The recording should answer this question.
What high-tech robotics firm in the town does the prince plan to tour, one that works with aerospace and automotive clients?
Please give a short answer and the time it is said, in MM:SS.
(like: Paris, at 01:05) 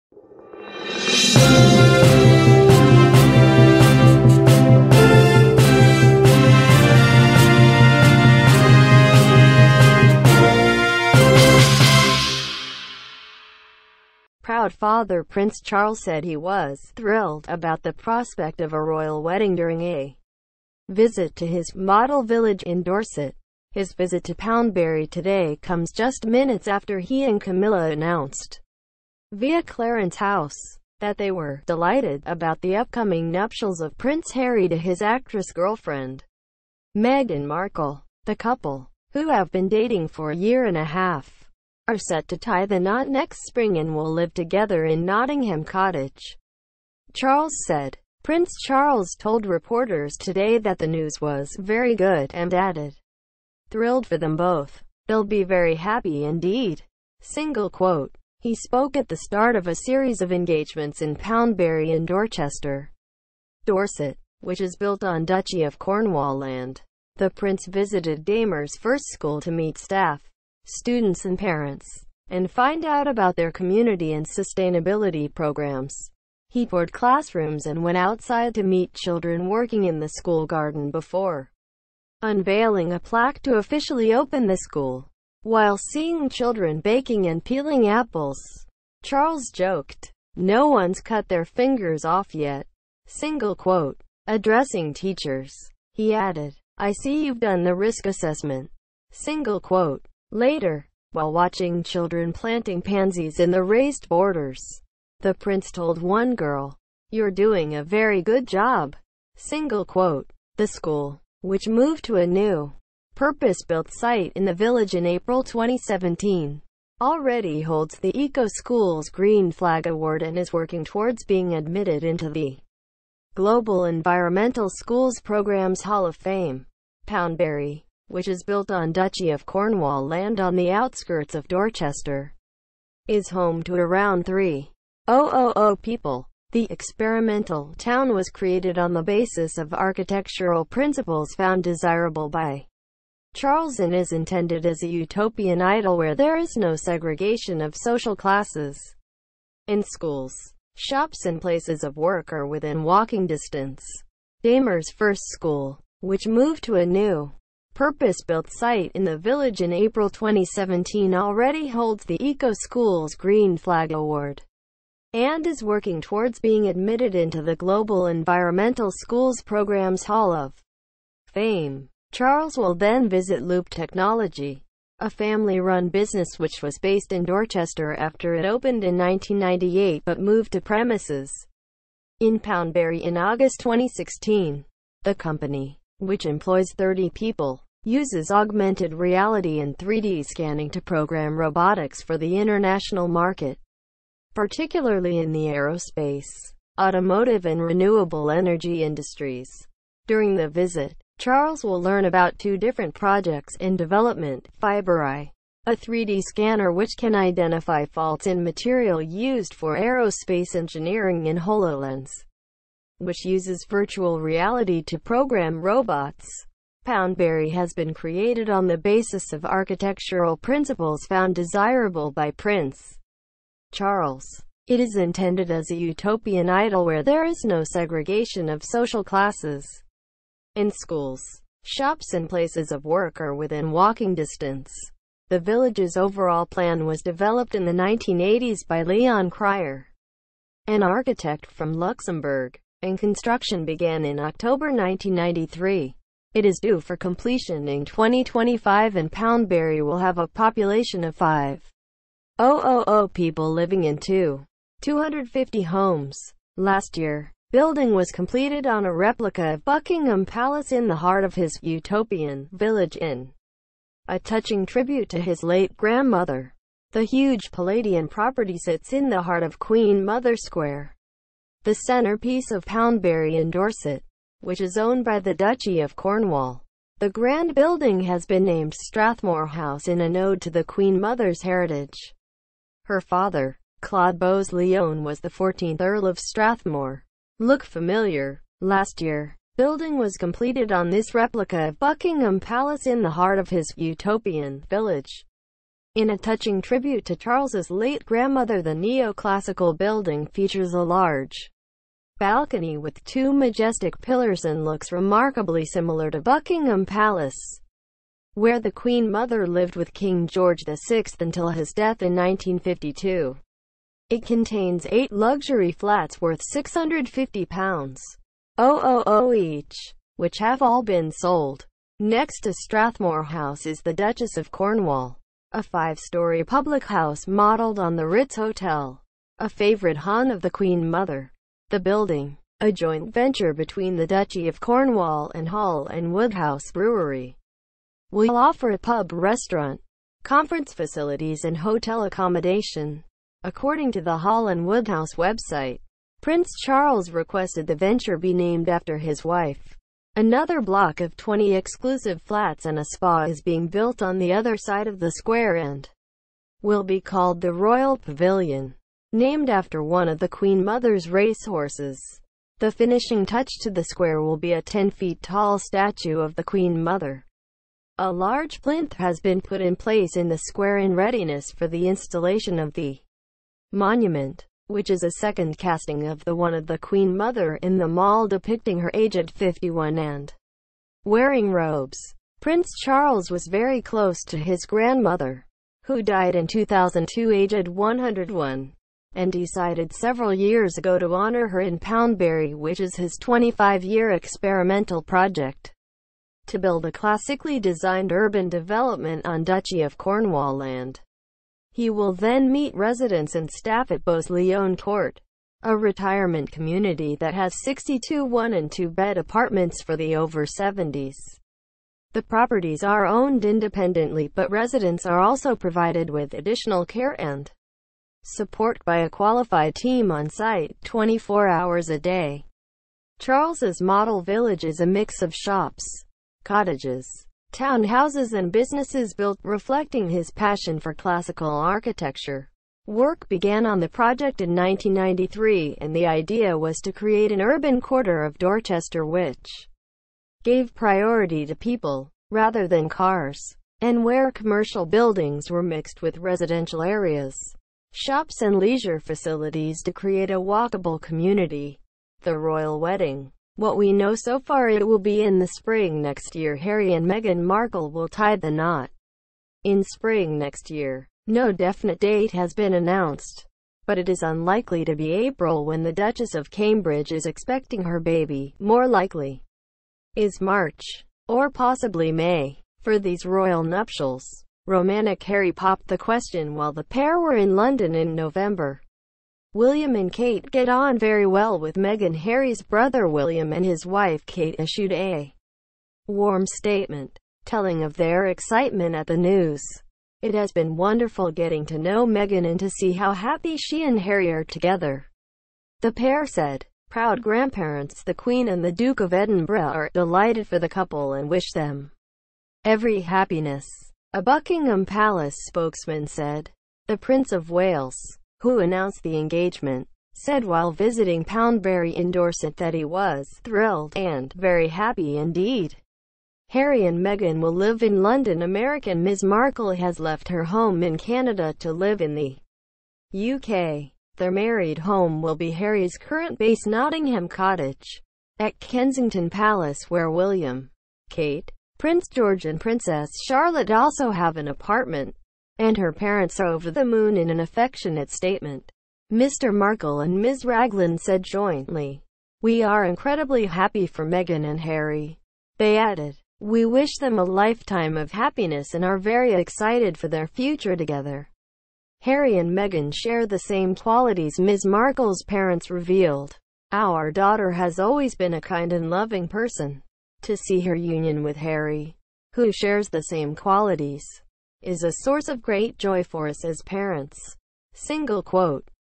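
Loop Technology, at 02:53.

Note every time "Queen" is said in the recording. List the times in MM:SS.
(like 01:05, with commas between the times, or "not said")
04:29, 04:40, 05:08, 05:30, 06:00, 06:06, 06:16, 08:18.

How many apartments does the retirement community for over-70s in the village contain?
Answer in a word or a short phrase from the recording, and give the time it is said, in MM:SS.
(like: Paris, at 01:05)
62, at 06:47.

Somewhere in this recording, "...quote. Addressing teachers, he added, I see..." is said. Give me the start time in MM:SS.
01:33.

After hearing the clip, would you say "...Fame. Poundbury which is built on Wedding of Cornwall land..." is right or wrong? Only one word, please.
wrong.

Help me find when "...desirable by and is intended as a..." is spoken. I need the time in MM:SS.
02:21.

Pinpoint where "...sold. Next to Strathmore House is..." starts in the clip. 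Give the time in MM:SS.
05:21.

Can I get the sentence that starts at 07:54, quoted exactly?
Romantic Harry popped the question while the pair were in London in November.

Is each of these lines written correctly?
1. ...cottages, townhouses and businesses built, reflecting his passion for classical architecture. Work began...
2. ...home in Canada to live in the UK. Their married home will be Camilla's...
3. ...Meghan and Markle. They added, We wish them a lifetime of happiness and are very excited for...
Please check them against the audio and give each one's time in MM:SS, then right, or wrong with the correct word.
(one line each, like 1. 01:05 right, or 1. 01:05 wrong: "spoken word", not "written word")
1. 07:06 right
2. 08:40 wrong: "Harry", not "Camilla"
3. 09:04 wrong: "Harry", not "Markle".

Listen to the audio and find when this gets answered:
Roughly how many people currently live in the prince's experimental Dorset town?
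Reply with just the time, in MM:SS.
02:14.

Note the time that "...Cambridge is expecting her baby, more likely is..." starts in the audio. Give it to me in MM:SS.
07:46.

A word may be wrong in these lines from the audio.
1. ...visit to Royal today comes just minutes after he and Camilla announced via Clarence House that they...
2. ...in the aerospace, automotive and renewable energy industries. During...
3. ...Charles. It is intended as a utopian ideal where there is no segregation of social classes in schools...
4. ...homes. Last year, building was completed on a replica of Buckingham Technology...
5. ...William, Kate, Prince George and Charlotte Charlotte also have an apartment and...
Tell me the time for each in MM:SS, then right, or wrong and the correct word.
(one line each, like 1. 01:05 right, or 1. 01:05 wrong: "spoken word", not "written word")
1. 00:23 wrong: "Poundbury", not "Royal"
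2. 03:15 right
3. 03:43 right
4. 04:15 wrong: "Palace", not "Technology"
5. 08:50 wrong: "Princess", not "Charlotte".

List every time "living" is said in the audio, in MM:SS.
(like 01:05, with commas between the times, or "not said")
04:13.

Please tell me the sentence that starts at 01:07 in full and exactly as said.
The prince visited Damer's first school to meet staff students and parents, and find out about their community and sustainability programs.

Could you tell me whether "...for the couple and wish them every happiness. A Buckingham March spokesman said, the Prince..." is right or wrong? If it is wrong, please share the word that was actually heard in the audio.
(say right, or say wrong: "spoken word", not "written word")
wrong: "Palace", not "March".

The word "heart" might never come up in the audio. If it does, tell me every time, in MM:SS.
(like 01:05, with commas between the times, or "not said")
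04:20, 04:29, 04:53.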